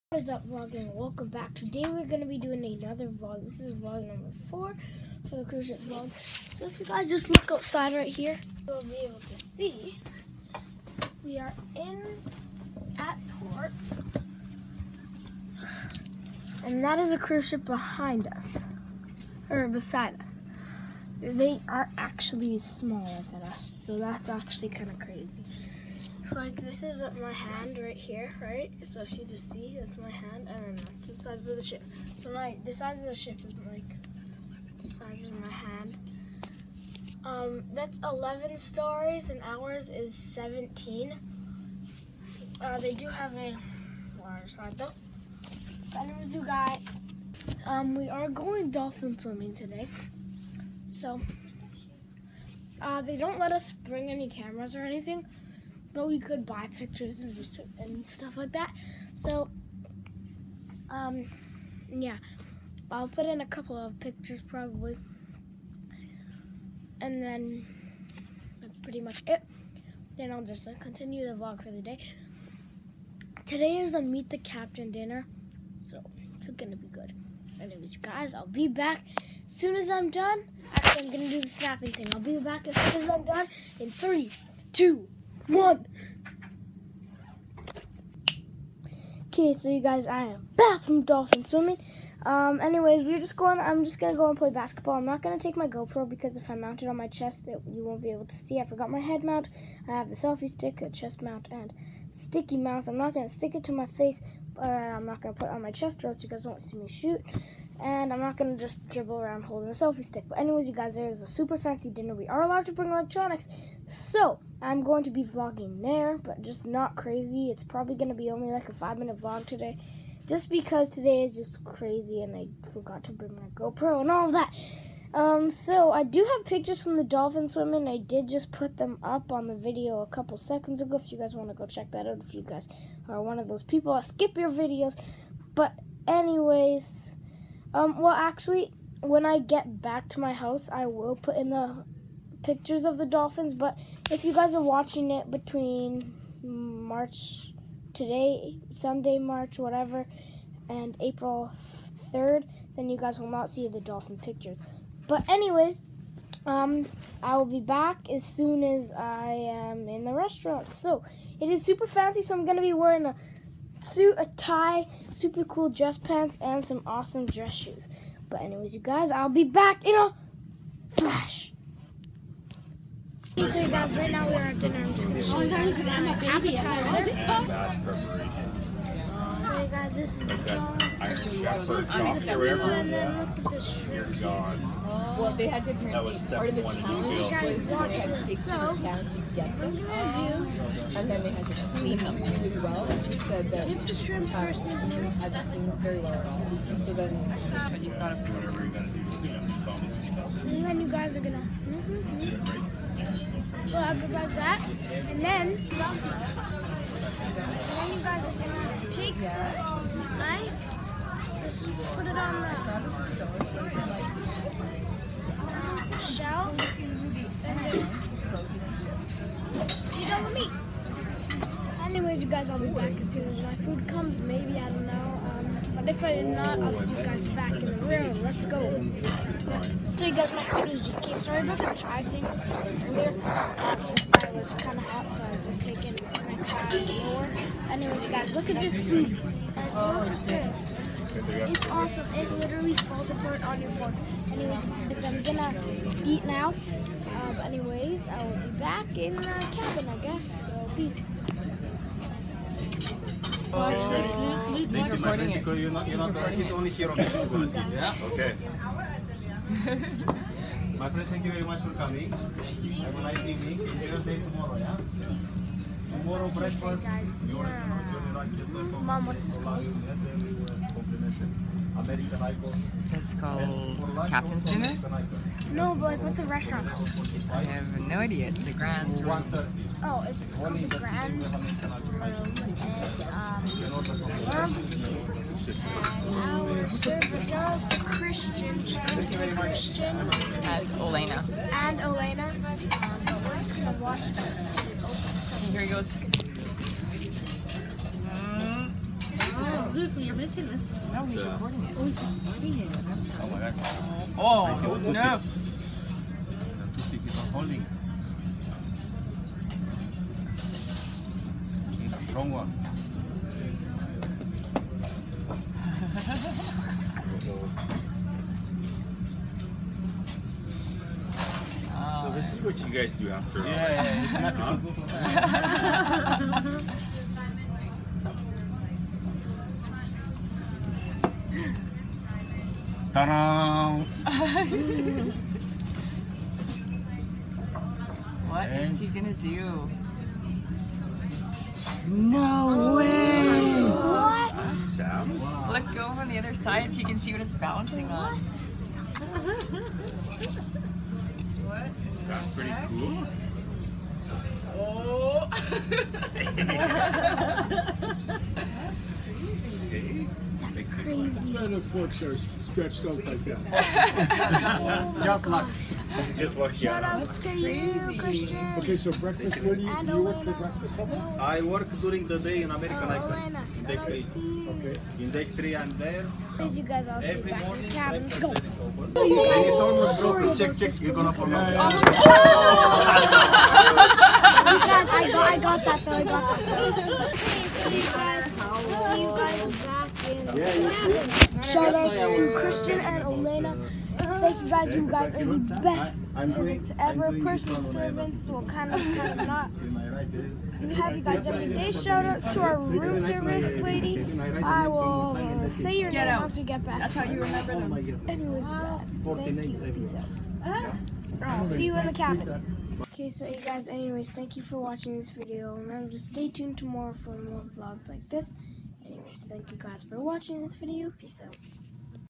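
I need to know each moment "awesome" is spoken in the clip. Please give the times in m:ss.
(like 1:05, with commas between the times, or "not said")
2:46, 4:01.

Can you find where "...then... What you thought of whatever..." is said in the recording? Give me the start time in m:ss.
3:16.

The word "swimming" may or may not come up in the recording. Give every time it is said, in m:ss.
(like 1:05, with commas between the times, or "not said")
0:49, 1:31, 2:07.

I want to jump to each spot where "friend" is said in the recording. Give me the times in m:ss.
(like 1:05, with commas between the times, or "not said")
4:15, 4:20.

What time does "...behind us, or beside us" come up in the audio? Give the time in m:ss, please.
0:17.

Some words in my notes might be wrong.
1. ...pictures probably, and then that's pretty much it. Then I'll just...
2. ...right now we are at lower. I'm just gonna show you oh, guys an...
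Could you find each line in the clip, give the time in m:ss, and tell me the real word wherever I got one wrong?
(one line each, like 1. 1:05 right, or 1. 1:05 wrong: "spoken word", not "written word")
1. 1:03 right
2. 2:53 wrong: "dinner", not "lower".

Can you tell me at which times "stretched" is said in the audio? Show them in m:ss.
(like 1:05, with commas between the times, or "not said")
6:02.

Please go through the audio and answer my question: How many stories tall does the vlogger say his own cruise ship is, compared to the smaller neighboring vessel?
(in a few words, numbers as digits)
17.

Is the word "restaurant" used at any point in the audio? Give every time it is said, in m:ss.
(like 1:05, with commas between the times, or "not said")
2:40, 4:36.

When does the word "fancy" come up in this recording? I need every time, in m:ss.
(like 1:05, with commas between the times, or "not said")
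1:51, 2:41.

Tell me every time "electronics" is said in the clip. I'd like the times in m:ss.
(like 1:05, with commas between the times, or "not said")
1:52.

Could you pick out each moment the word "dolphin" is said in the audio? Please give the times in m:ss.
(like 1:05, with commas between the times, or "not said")
0:48, 1:31, 2:07, 2:23, 2:33.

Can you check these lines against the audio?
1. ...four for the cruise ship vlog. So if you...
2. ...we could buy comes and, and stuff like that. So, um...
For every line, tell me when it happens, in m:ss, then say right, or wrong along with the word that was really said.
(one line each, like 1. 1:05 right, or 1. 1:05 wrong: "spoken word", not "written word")
1. 0:04 right
2. 0:56 wrong: "pictures", not "comes".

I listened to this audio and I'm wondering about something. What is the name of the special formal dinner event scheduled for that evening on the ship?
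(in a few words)
Meet the captain dinner.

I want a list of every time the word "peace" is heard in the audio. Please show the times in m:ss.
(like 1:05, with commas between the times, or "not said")
4:10, 6:49, 7:00.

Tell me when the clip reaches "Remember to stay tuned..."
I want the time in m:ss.
6:55.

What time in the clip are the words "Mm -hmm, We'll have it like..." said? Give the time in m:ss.
3:21.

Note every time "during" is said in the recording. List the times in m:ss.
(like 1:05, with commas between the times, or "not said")
6:11.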